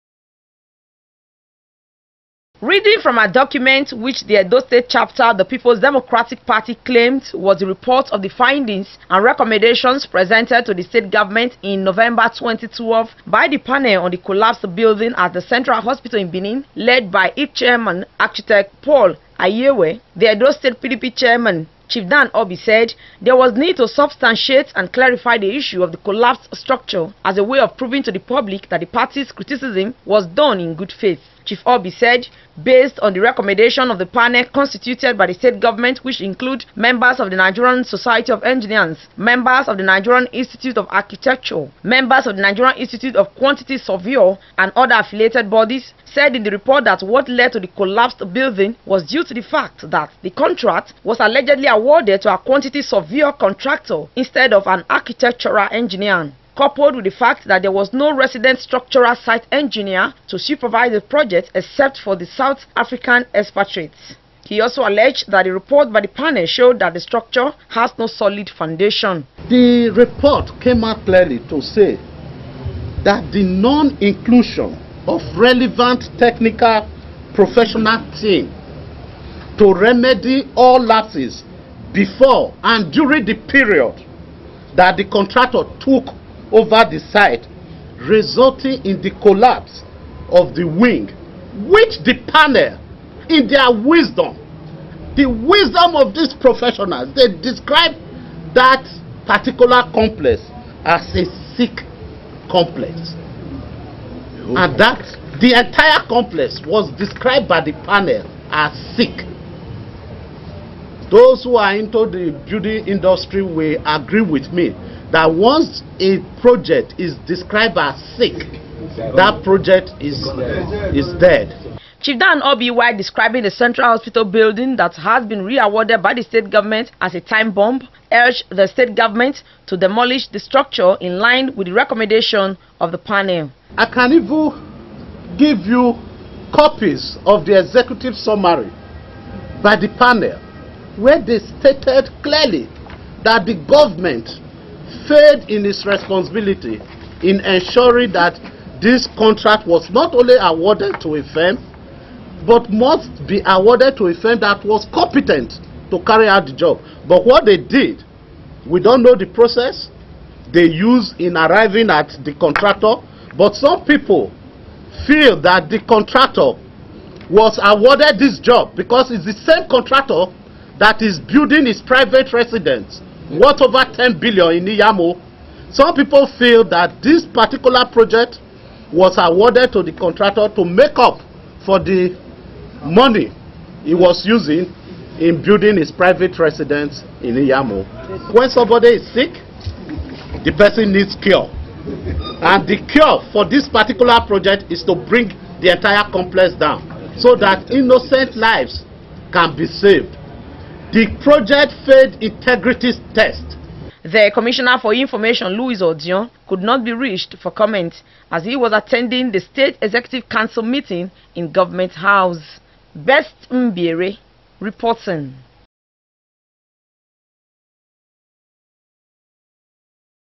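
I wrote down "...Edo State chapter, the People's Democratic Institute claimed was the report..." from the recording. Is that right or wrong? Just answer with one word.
wrong.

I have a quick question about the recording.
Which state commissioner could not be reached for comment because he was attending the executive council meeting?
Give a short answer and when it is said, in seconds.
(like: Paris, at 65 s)
Louis Odion, at 205 s.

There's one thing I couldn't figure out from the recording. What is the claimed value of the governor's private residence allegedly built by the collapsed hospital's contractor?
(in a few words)
Over 10 billion.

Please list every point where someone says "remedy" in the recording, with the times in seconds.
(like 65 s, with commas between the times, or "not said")
79 s.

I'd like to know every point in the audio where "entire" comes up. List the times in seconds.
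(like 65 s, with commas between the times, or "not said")
105 s, 195 s.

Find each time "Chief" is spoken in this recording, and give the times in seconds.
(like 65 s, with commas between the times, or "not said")
21 s, 31 s, 121 s.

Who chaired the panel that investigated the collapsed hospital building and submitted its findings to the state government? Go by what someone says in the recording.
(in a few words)
Paul Ayewe.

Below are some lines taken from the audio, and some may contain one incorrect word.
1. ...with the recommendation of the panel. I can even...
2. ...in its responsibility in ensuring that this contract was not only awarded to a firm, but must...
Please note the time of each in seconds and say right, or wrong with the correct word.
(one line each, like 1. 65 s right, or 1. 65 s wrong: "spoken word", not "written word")
1. 131 s right
2. 145 s right.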